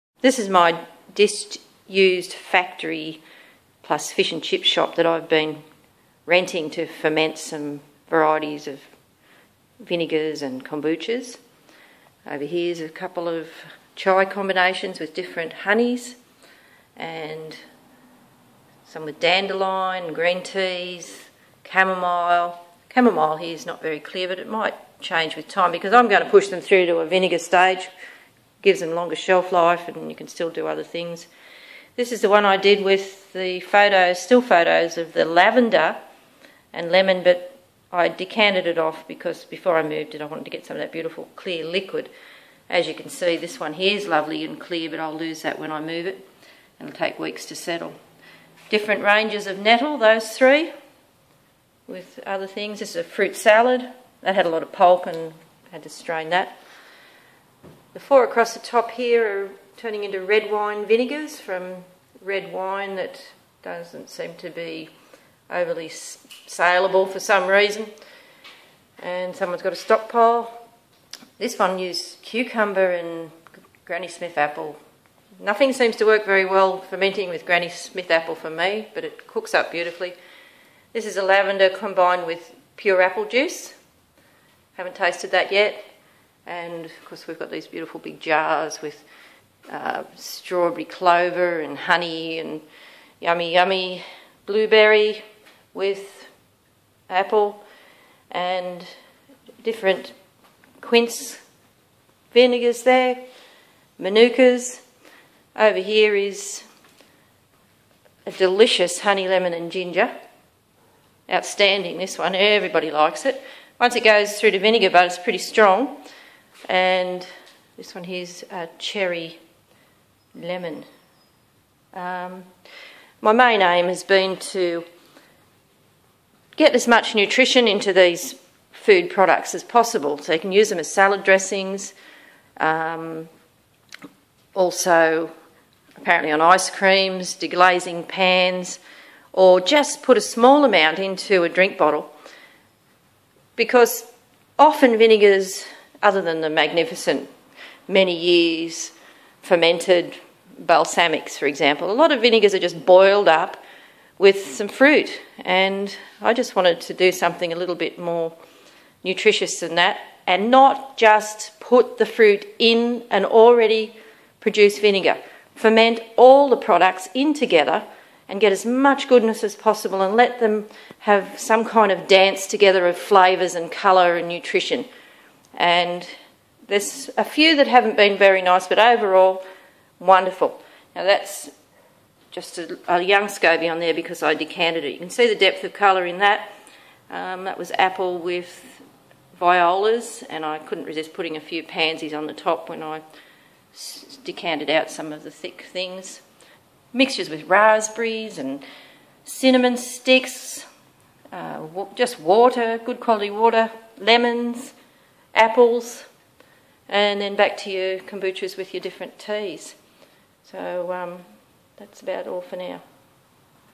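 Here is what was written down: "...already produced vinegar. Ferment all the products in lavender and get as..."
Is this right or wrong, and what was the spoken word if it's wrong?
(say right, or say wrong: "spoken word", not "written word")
wrong: "together", not "lavender".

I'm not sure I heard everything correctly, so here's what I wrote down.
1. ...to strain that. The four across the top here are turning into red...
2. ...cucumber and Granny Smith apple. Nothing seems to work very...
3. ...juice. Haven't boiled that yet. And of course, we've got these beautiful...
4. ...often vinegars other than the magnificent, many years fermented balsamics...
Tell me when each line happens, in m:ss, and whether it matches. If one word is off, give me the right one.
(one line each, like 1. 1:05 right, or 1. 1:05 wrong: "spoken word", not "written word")
1. 0:55 right
2. 1:12 right
3. 1:23 wrong: "tasted", not "boiled"
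4. 2:24 right.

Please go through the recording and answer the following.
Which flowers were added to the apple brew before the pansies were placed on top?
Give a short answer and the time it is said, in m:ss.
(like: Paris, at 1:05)
Violas, at 3:09.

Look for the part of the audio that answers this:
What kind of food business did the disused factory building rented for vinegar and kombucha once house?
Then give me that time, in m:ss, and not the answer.
0:04.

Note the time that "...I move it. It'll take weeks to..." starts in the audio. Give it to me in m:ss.
0:45.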